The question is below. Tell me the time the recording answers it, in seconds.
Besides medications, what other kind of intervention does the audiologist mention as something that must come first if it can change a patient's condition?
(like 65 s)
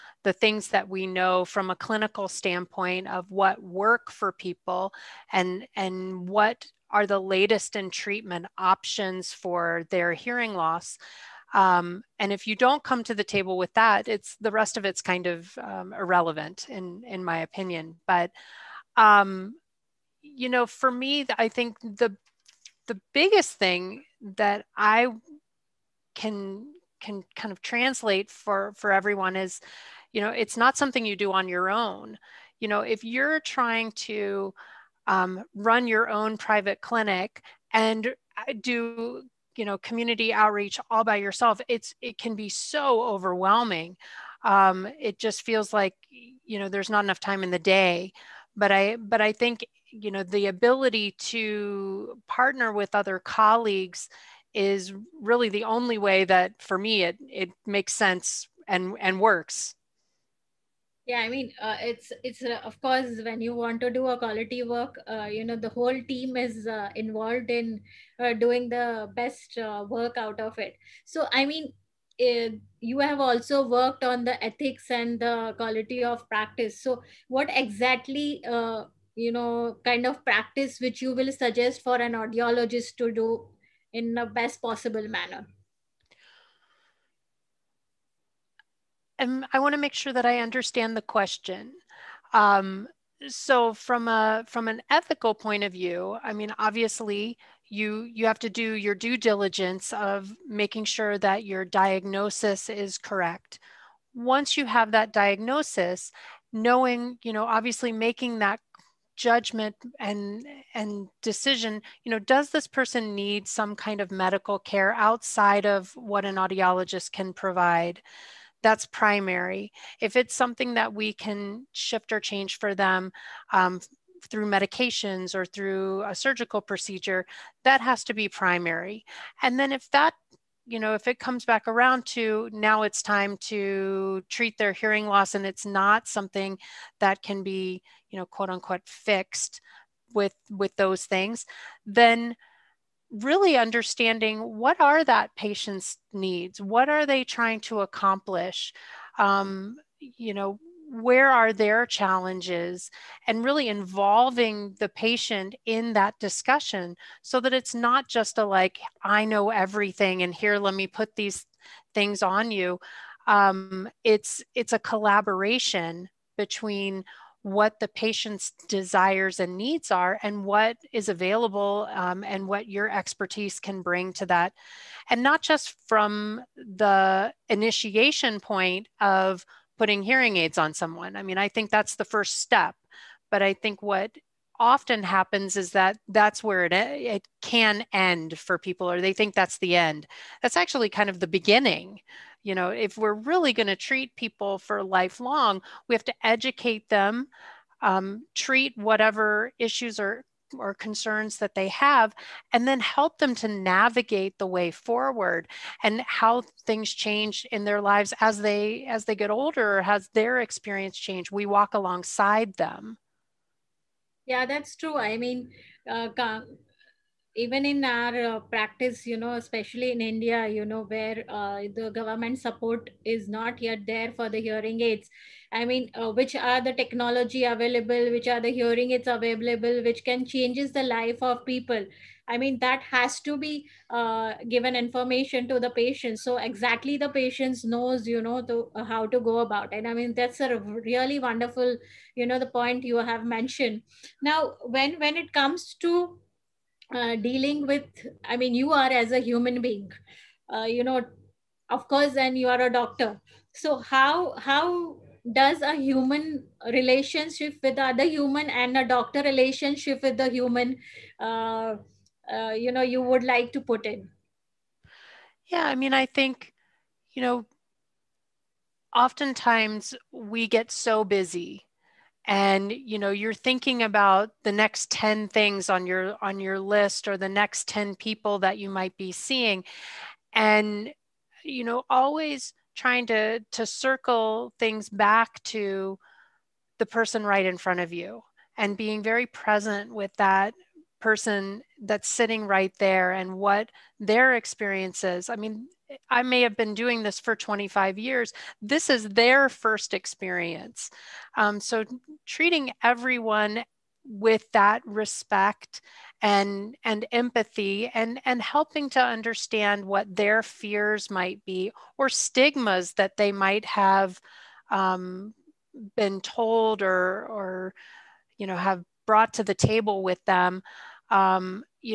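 126 s.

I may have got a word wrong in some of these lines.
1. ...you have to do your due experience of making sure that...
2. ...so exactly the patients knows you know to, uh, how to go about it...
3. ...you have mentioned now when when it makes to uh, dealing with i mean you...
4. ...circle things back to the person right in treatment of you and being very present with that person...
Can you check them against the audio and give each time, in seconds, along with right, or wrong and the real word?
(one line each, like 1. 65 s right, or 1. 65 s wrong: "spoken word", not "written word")
1. 98 s wrong: "diligence", not "experience"
2. 236 s right
3. 242 s wrong: "comes", not "makes"
4. 283 s wrong: "front", not "treatment".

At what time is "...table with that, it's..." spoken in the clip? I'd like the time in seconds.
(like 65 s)
13 s.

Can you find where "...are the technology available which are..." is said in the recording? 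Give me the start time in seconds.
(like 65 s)
226 s.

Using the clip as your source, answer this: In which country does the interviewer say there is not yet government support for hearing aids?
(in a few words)
India.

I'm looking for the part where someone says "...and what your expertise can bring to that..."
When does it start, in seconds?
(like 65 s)
172 s.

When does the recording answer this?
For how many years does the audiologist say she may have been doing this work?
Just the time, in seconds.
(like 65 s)
297 s.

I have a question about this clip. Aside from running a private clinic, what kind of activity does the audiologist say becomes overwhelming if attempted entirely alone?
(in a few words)
Community outreach.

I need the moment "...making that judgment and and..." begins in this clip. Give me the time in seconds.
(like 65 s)
107 s.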